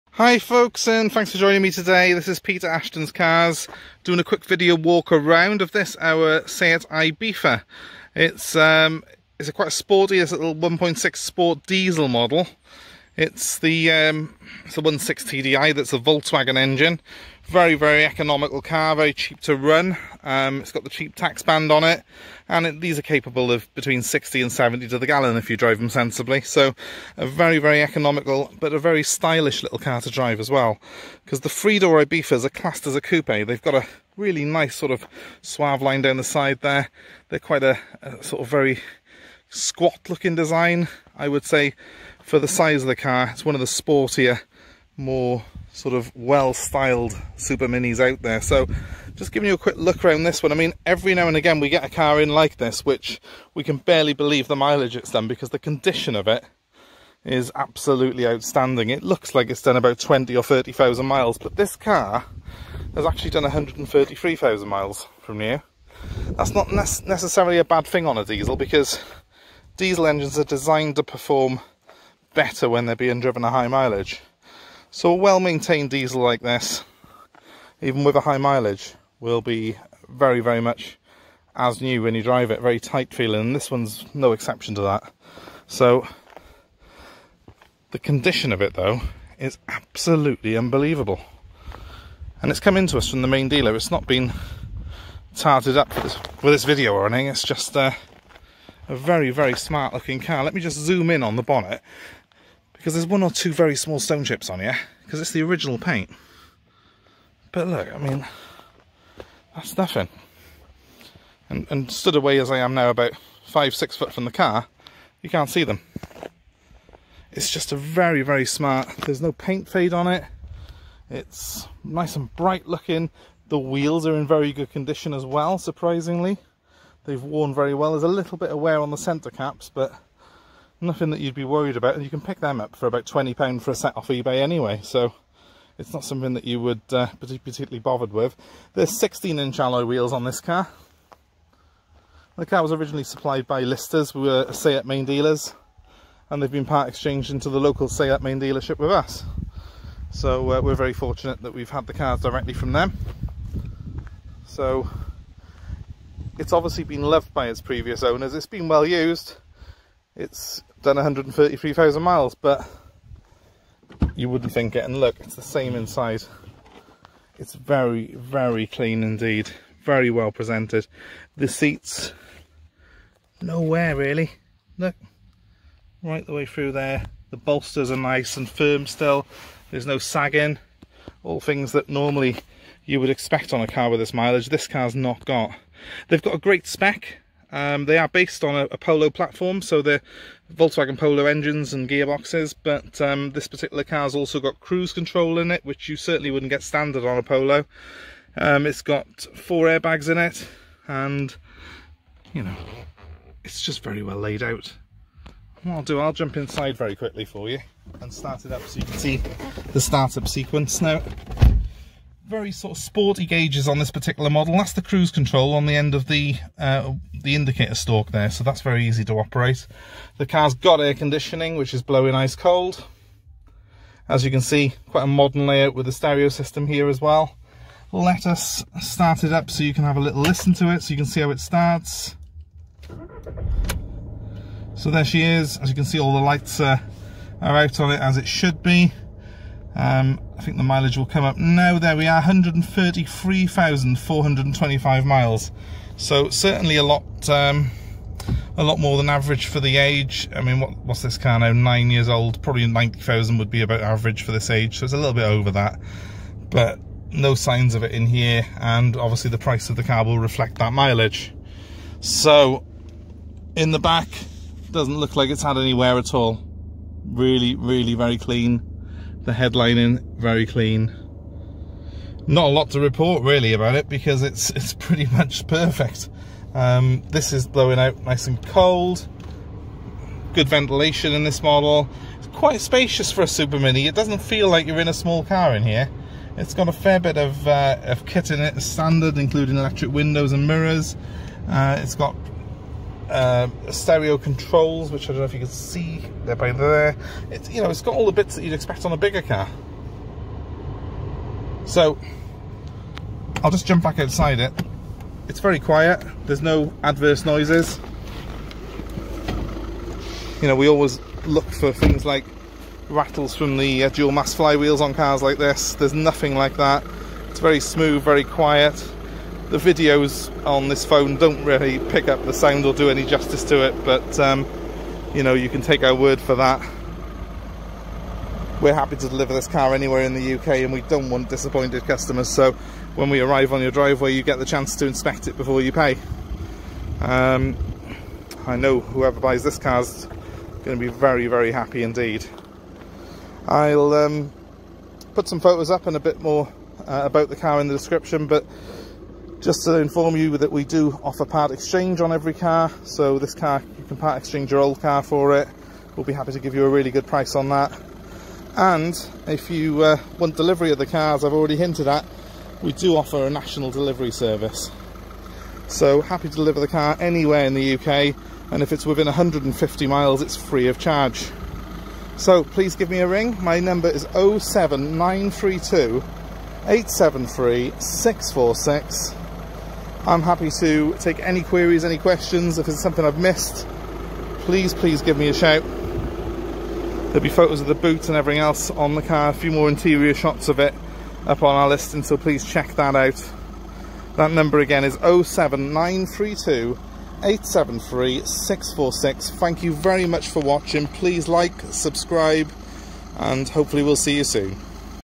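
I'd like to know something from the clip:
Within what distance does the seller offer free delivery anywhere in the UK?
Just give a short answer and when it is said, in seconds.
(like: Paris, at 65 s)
150 miles, at 369 s.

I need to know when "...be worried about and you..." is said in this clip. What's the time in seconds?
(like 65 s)
131 s.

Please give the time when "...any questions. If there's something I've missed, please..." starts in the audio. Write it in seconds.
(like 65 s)
381 s.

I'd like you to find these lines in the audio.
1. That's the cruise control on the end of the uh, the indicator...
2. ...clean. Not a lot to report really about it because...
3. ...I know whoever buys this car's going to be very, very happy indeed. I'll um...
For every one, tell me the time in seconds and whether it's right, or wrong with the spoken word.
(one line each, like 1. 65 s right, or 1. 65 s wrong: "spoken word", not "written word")
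1. 214 s right
2. 270 s right
3. 338 s right.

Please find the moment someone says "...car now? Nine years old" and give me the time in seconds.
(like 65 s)
251 s.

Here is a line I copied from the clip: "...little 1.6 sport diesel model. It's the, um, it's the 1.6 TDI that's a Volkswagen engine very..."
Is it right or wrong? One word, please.
right.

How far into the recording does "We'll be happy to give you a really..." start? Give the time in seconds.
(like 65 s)
355 s.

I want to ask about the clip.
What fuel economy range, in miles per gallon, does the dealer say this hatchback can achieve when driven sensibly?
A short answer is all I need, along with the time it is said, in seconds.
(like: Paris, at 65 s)
60 to 70, at 23 s.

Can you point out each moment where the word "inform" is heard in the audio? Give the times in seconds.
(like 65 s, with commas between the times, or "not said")
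349 s.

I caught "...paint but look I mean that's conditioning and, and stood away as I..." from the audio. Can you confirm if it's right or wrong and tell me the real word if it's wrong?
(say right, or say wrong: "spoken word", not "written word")
wrong: "nothing", not "conditioning".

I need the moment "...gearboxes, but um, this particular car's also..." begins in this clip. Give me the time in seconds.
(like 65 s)
191 s.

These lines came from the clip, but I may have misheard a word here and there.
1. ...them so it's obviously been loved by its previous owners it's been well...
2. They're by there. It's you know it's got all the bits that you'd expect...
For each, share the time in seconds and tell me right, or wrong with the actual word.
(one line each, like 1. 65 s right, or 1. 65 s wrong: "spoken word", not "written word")
1. 152 s right
2. 296 s right.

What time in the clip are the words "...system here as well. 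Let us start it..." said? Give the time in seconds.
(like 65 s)
226 s.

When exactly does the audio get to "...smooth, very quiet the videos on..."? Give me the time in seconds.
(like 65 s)
317 s.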